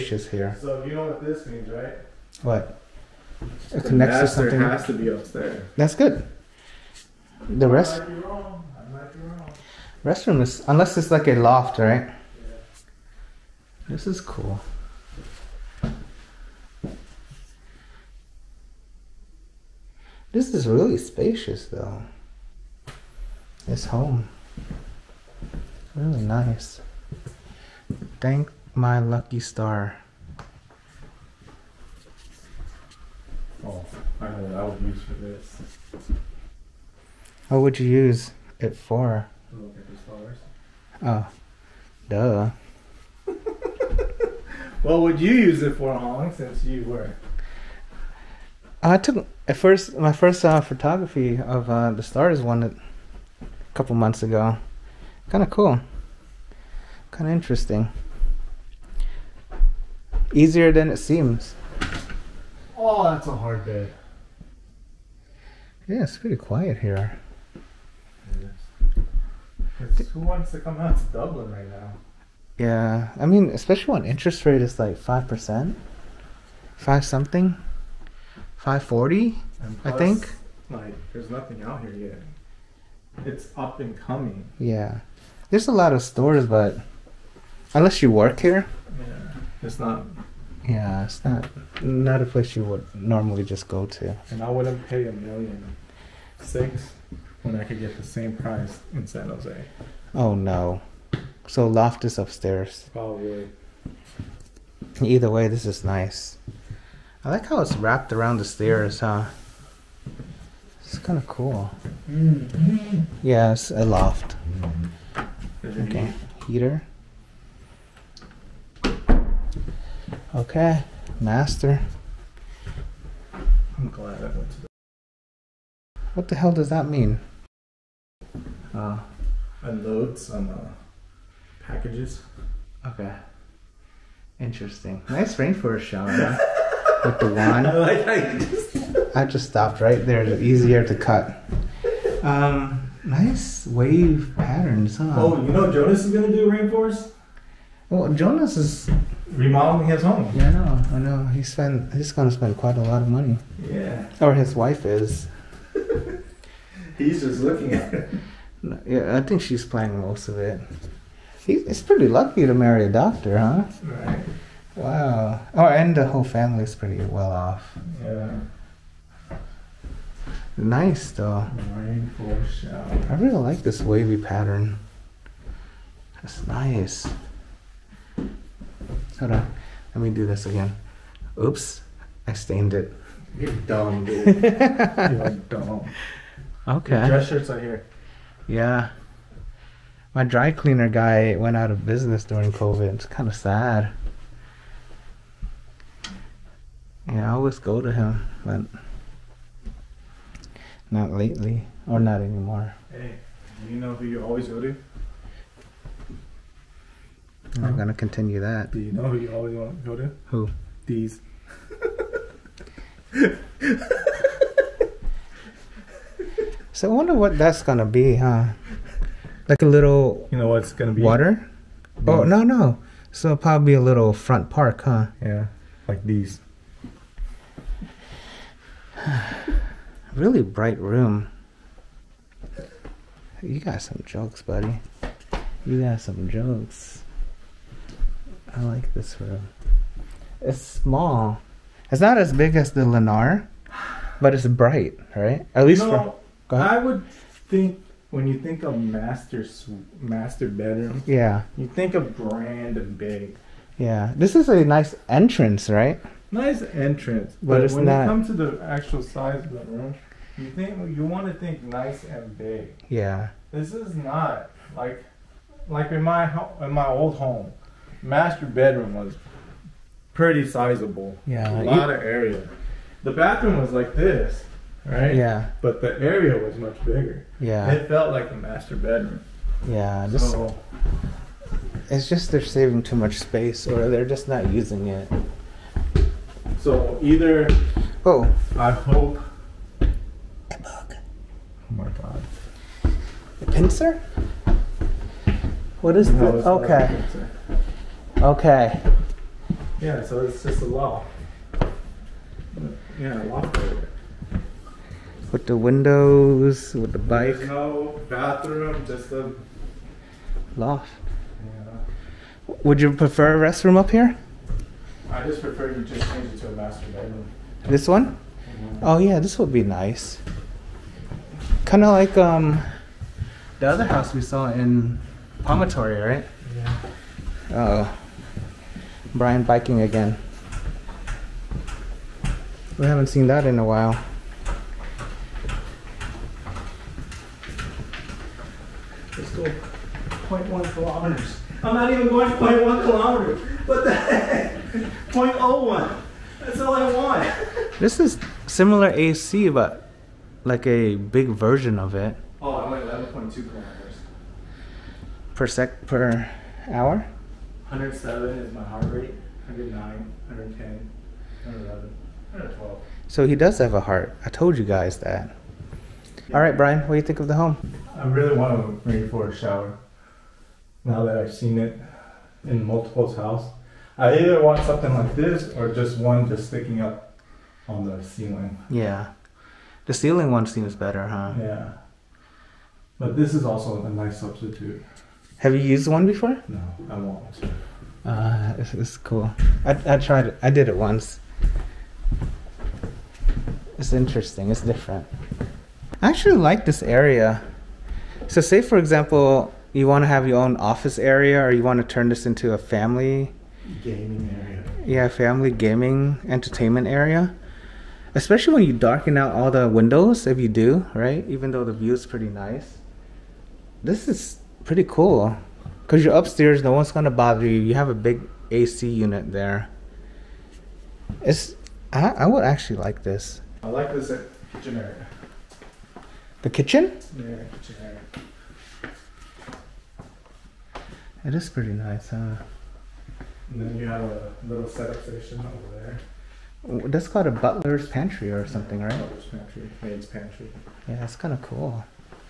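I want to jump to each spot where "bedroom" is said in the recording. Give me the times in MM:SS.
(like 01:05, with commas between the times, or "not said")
04:10, 04:28, 04:38, 05:16.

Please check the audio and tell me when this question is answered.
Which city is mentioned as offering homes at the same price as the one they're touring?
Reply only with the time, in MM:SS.
01:39.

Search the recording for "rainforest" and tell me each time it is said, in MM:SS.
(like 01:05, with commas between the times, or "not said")
02:15, 02:26, 02:51, 06:08.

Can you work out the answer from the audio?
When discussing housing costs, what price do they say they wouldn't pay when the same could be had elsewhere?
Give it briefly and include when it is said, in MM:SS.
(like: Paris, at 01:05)
a million six, at 01:35.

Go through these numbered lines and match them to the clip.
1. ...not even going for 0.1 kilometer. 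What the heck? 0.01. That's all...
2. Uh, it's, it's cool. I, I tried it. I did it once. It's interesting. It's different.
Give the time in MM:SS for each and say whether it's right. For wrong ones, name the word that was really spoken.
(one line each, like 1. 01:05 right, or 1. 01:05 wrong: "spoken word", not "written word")
1. 05:41 right
2. 06:28 right.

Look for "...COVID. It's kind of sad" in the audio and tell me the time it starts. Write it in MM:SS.
03:12.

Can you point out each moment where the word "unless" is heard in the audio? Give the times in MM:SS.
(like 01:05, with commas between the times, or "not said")
00:10, 01:27.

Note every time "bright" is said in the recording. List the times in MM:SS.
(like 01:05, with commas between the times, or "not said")
03:50, 04:04.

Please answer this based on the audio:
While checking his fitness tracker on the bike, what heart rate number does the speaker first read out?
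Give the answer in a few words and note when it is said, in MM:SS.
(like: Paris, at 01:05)
107, at 05:57.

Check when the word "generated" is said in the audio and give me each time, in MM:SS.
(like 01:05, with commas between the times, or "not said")
not said.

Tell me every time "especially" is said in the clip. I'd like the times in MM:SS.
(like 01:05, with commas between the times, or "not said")
01:13, 06:48.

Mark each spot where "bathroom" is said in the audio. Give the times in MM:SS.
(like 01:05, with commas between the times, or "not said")
04:33, 05:08.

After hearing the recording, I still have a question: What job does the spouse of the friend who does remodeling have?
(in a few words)
doctor.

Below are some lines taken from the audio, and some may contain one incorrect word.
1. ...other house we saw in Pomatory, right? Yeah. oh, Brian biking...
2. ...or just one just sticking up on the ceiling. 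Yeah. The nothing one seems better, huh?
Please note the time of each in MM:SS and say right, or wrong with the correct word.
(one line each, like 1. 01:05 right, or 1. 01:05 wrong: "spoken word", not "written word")
1. 05:23 right
2. 06:15 wrong: "ceiling", not "nothing".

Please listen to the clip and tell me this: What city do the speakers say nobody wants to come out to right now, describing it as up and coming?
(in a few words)
Dublin.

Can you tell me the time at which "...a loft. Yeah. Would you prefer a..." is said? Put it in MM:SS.
05:09.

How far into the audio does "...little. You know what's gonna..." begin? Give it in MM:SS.
03:39.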